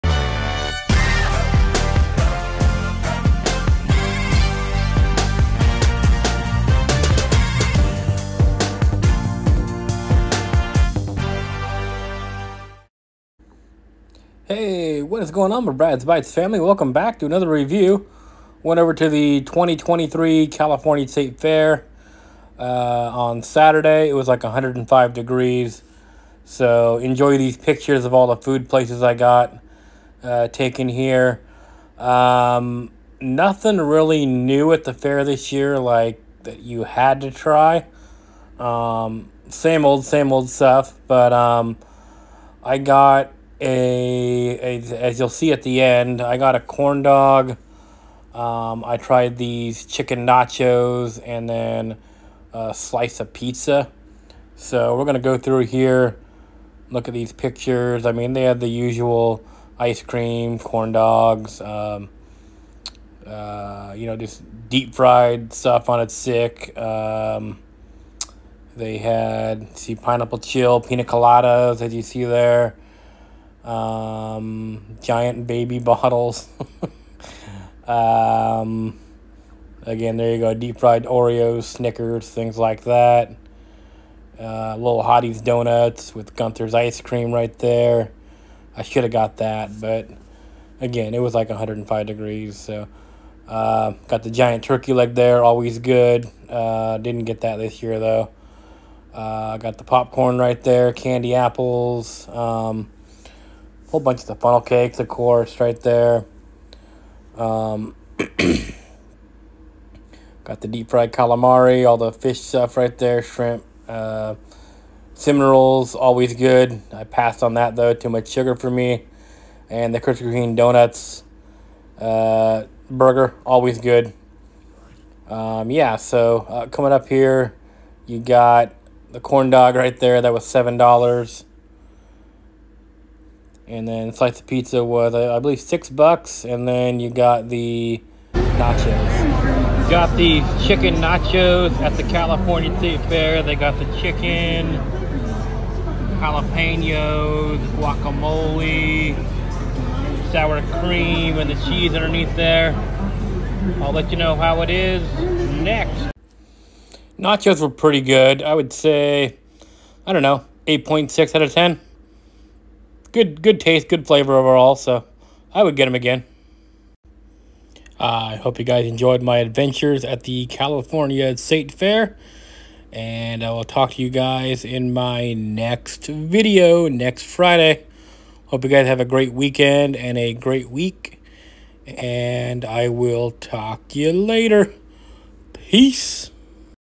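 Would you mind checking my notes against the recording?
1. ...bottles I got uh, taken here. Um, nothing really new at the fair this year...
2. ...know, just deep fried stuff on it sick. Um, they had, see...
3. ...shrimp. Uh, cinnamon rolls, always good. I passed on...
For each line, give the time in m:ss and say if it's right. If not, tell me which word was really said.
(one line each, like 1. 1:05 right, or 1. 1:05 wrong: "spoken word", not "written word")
1. 0:28 wrong: "places", not "bottles"
2. 1:04 right
3. 1:53 right.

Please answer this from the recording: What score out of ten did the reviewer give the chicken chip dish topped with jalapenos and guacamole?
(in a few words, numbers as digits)
8.6.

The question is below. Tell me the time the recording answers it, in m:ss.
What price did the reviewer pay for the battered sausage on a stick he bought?
2:10.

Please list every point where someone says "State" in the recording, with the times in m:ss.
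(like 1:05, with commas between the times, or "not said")
0:21, 2:22, 2:51.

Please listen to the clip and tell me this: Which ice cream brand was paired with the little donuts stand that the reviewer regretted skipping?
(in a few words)
Gunther's.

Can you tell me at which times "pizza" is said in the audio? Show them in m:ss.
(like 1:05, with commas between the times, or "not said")
0:53, 2:14.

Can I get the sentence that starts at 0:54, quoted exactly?
So we're going to go through here, look at these pictures.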